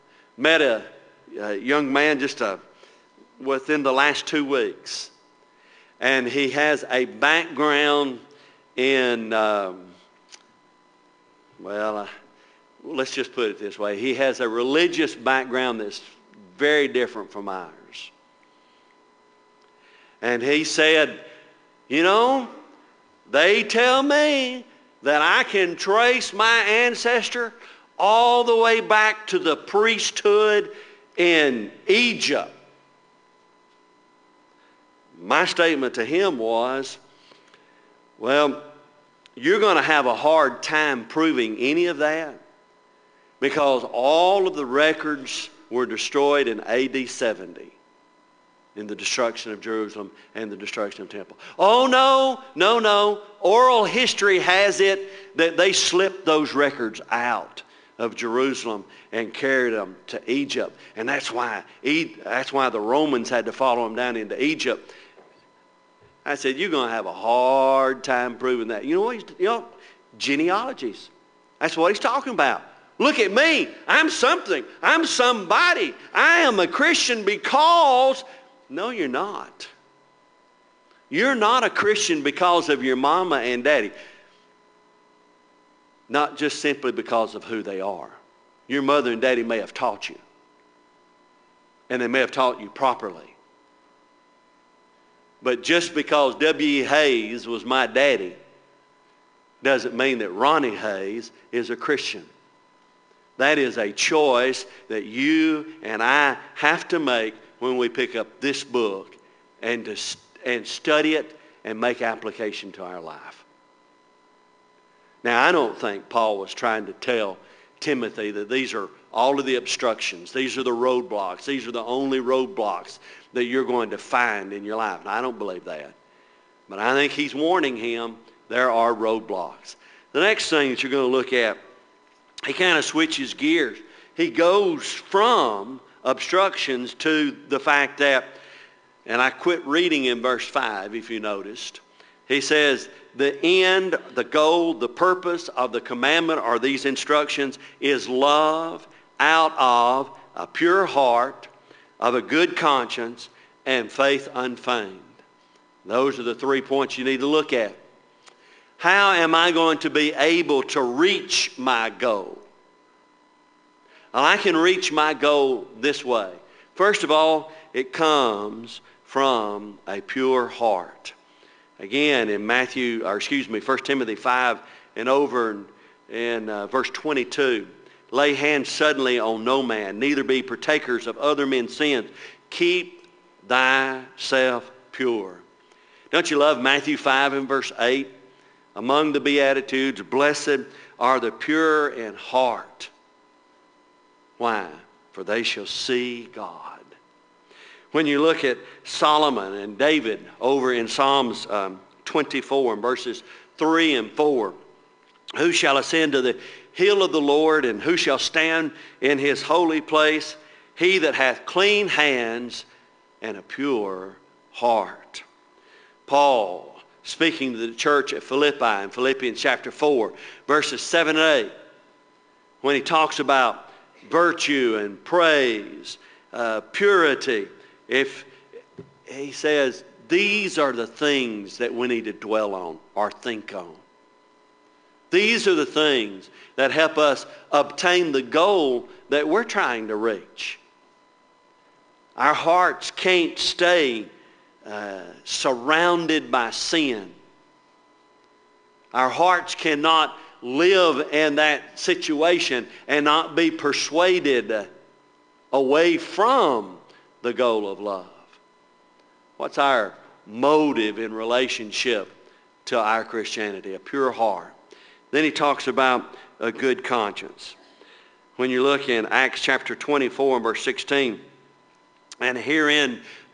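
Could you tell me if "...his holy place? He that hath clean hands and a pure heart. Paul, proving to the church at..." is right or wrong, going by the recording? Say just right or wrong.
wrong.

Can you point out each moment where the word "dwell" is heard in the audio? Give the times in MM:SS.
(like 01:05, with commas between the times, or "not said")
03:52.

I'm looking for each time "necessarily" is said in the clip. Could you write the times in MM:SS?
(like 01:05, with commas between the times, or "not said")
not said.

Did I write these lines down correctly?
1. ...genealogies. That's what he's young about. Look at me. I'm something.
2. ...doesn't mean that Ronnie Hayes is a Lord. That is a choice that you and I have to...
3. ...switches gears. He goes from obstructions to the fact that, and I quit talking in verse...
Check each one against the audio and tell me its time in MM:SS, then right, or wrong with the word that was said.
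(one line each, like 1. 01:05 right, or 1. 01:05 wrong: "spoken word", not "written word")
1. 01:10 wrong: "talking", not "young"
2. 01:39 wrong: "Christian", not "Lord"
3. 02:12 wrong: "reading", not "talking".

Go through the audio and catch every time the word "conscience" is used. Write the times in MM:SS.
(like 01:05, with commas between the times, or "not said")
02:32, 04:26.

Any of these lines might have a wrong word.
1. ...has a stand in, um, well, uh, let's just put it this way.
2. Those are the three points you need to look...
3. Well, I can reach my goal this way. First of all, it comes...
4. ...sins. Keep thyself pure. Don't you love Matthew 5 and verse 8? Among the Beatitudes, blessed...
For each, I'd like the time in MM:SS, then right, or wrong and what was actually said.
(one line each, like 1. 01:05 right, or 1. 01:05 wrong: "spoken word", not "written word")
1. 00:06 wrong: "background", not "stand"
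2. 02:35 right
3. 02:44 right
4. 03:01 right.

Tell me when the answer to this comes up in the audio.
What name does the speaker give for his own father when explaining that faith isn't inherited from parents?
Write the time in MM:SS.
01:36.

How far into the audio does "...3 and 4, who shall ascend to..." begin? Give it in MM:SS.
03:23.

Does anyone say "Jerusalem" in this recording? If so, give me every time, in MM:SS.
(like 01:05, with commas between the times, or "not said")
00:49, 00:58.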